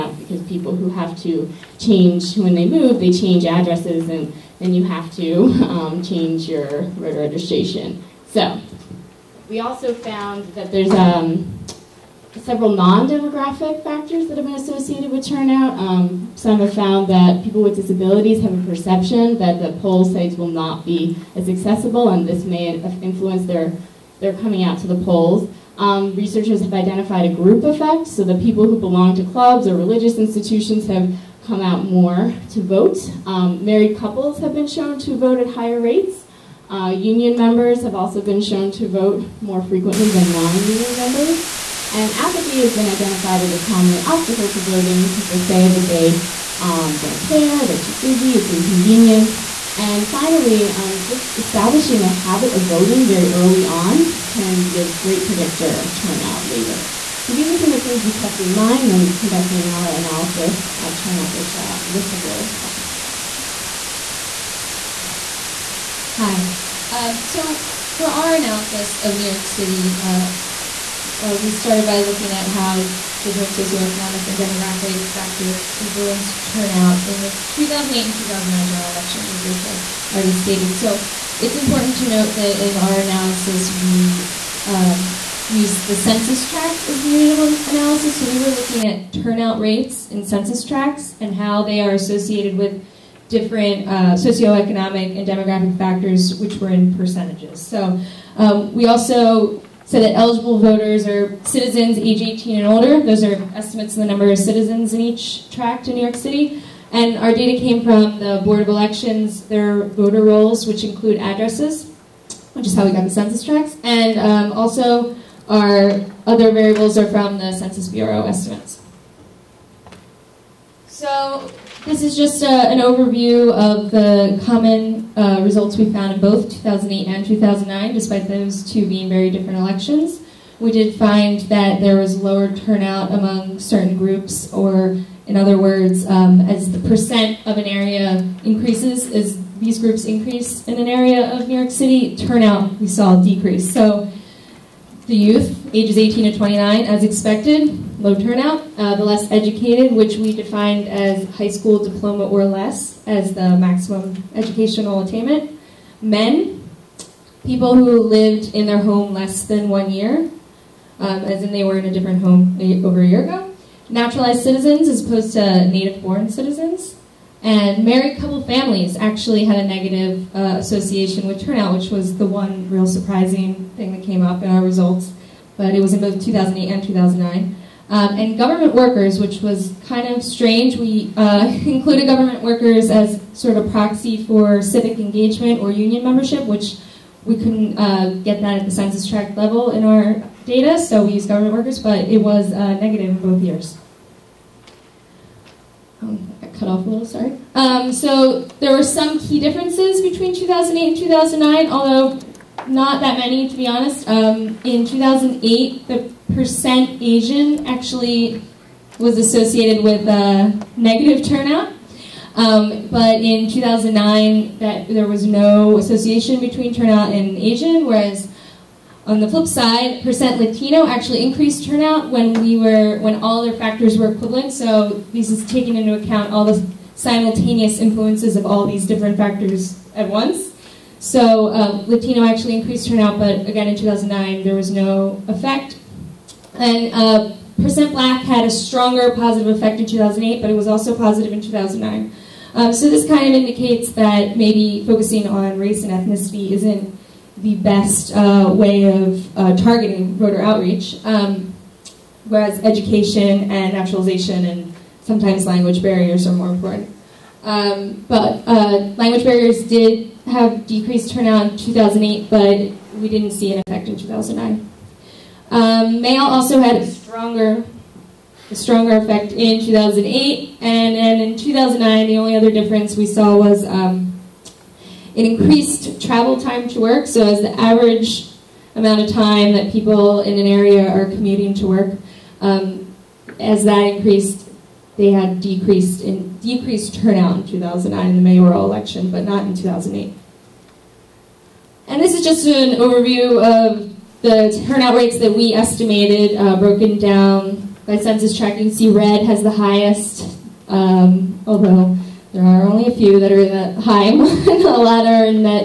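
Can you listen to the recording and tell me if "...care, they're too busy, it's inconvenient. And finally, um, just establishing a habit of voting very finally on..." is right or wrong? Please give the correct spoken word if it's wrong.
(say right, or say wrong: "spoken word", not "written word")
wrong: "early", not "finally".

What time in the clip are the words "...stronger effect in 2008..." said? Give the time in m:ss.
4:28.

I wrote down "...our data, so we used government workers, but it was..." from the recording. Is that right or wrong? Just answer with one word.
right.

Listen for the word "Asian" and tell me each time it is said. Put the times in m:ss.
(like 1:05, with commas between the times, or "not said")
3:27, 3:37.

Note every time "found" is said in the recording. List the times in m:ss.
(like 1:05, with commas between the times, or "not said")
0:09, 0:16, 2:05.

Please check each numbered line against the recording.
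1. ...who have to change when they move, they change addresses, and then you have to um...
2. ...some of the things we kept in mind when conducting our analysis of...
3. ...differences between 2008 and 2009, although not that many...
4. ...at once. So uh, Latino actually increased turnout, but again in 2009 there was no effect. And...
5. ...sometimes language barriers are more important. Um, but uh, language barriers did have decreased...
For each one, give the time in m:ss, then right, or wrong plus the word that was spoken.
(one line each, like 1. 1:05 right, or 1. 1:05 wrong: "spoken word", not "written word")
1. 0:00 right
2. 0:57 right
3. 3:19 right
4. 3:49 right
5. 4:15 right.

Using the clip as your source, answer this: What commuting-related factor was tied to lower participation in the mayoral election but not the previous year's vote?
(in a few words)
travel time to work.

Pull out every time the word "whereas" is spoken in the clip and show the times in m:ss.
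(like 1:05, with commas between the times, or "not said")
3:37, 4:12.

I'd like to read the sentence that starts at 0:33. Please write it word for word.
Um, married couples have been shown to vote at higher rates.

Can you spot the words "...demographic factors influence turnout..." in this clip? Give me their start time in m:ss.
1:14.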